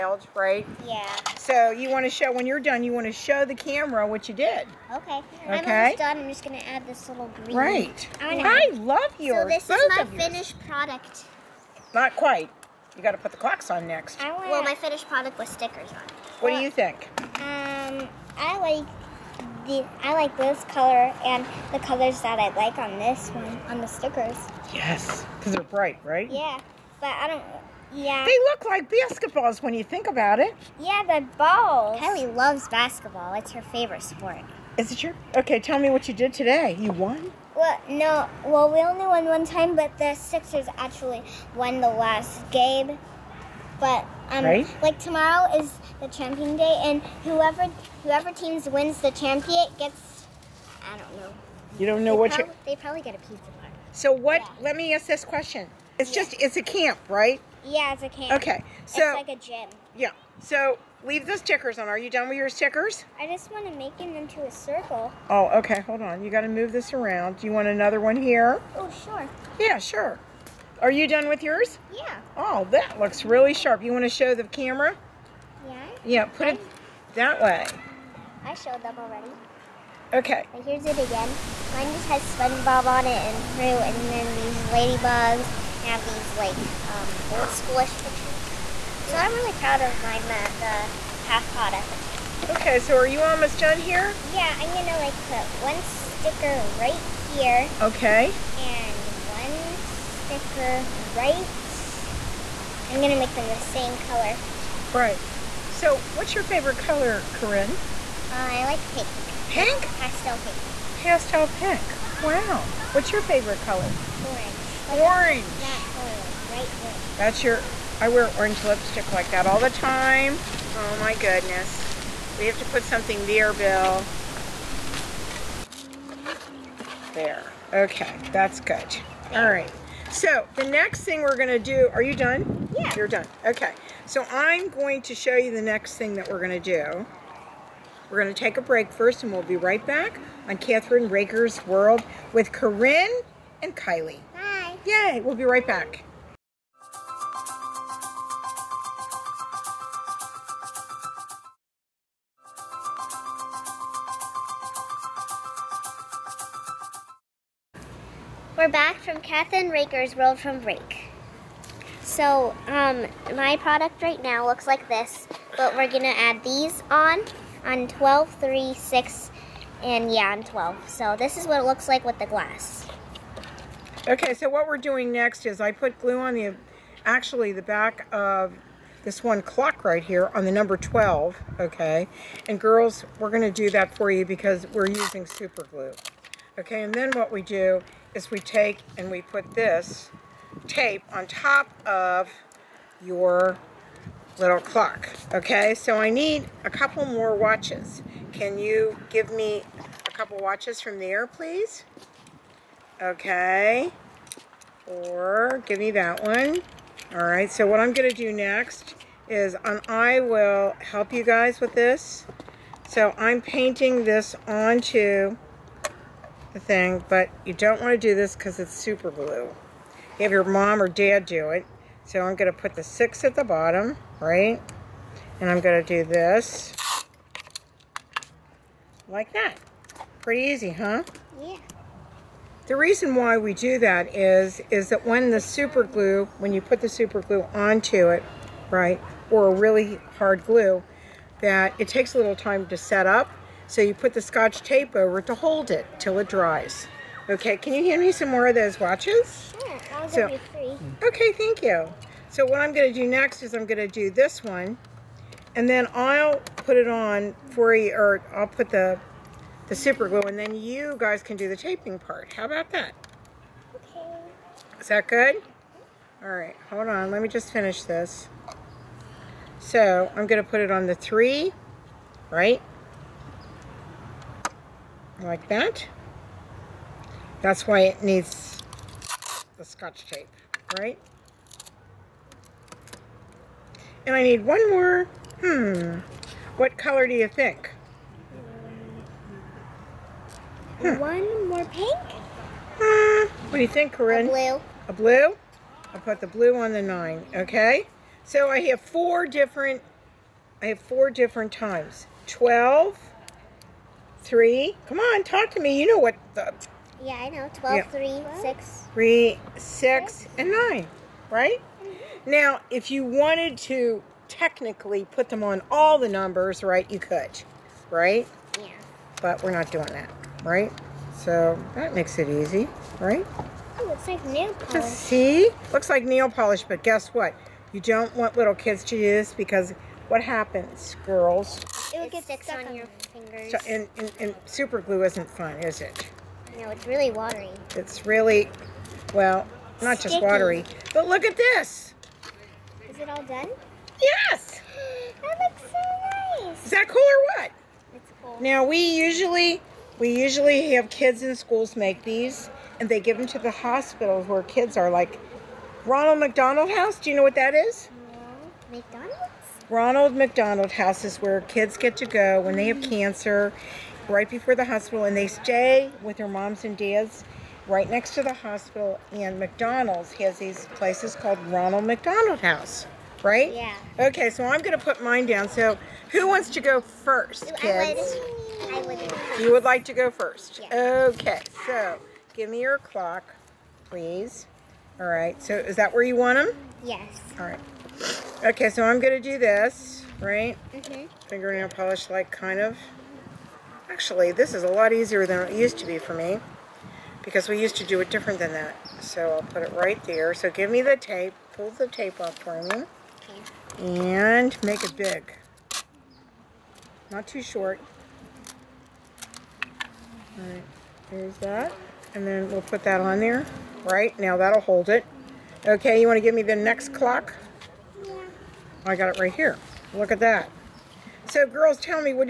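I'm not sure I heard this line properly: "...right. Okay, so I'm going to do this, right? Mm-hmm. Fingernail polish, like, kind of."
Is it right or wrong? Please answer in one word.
right.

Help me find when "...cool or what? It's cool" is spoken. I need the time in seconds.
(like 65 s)
346 s.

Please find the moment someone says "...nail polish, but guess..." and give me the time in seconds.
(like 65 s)
326 s.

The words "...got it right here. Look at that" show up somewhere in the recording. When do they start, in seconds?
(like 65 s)
418 s.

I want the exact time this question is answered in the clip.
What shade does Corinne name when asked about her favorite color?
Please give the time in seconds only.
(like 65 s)
109 s.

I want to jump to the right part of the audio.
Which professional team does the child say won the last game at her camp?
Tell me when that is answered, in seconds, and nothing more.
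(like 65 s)
39 s.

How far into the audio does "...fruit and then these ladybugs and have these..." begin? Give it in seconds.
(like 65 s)
83 s.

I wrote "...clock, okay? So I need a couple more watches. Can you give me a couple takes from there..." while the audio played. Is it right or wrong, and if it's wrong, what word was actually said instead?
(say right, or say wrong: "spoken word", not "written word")
wrong: "watches", not "takes".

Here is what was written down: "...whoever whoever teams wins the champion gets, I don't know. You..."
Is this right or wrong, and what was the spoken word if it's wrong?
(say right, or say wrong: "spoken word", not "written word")
right.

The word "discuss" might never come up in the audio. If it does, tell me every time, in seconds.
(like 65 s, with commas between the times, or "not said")
not said.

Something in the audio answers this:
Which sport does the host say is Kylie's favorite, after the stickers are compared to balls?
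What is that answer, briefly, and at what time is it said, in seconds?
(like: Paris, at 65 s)
Basketball, at 31 s.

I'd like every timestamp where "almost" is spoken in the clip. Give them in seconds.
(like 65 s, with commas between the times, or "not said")
5 s, 93 s.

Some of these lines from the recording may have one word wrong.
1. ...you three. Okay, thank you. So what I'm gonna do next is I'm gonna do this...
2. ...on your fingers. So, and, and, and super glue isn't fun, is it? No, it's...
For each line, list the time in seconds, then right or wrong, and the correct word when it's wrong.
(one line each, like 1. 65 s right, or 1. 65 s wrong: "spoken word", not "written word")
1. 250 s right
2. 332 s right.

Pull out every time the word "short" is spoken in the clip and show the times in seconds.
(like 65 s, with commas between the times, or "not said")
407 s.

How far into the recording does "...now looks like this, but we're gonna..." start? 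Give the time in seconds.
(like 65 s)
164 s.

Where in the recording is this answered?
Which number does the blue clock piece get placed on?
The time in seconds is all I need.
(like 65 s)
295 s.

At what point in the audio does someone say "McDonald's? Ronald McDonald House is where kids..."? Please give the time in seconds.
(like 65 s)
358 s.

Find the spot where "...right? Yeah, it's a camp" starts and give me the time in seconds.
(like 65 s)
57 s.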